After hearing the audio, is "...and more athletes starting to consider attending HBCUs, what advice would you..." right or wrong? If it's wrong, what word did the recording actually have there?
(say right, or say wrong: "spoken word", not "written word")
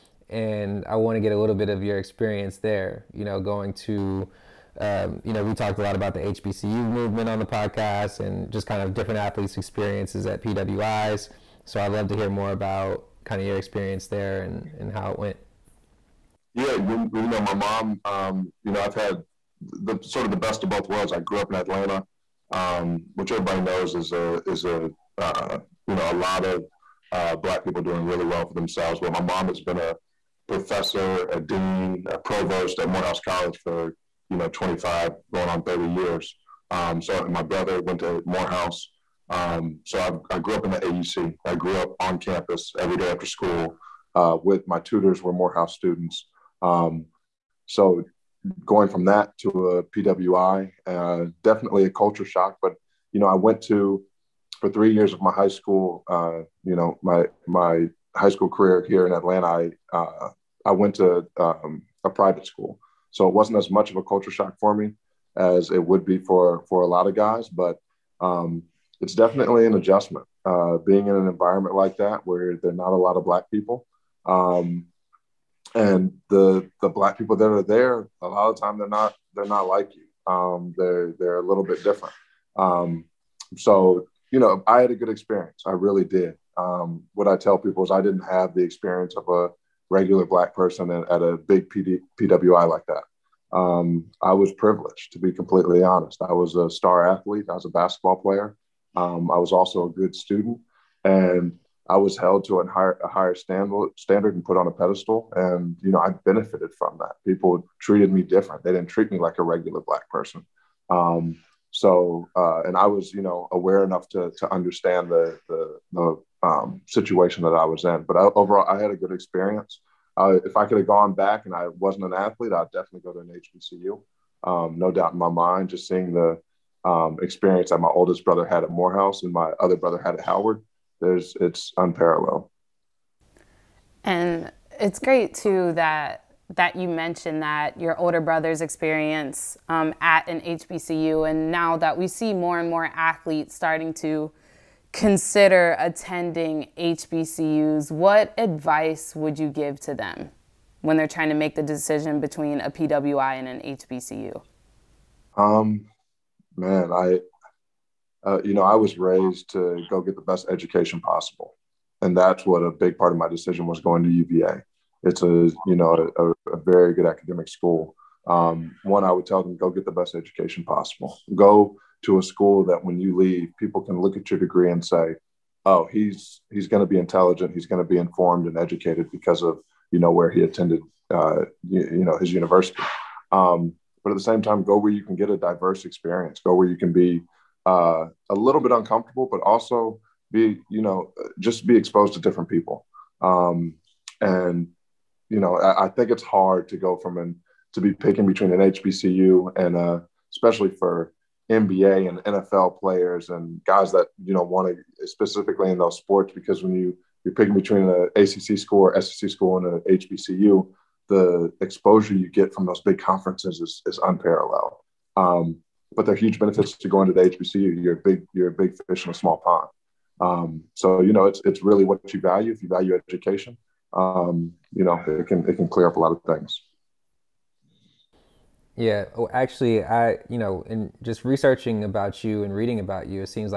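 right.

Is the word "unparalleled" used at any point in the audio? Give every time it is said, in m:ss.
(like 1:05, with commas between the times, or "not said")
2:11, 3:33.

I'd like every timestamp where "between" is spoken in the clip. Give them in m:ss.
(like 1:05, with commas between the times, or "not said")
2:32, 3:18, 3:27.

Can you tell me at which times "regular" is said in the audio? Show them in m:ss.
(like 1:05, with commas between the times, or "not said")
1:29, 1:49.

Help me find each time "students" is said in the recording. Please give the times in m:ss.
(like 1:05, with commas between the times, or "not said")
0:45, 1:40.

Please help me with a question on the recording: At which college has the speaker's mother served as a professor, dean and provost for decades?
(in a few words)
Morehouse College.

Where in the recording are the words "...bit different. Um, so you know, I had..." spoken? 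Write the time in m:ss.
1:21.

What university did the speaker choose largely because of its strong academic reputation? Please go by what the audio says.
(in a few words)
UVA.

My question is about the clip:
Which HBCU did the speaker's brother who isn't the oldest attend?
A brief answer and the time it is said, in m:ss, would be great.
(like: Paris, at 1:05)
Howard, at 2:10.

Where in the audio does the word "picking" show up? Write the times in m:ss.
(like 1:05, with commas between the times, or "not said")
3:17, 3:27.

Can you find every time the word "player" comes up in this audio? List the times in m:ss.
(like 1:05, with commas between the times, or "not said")
1:38, 3:22.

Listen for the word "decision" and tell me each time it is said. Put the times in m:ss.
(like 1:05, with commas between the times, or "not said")
2:31, 2:43.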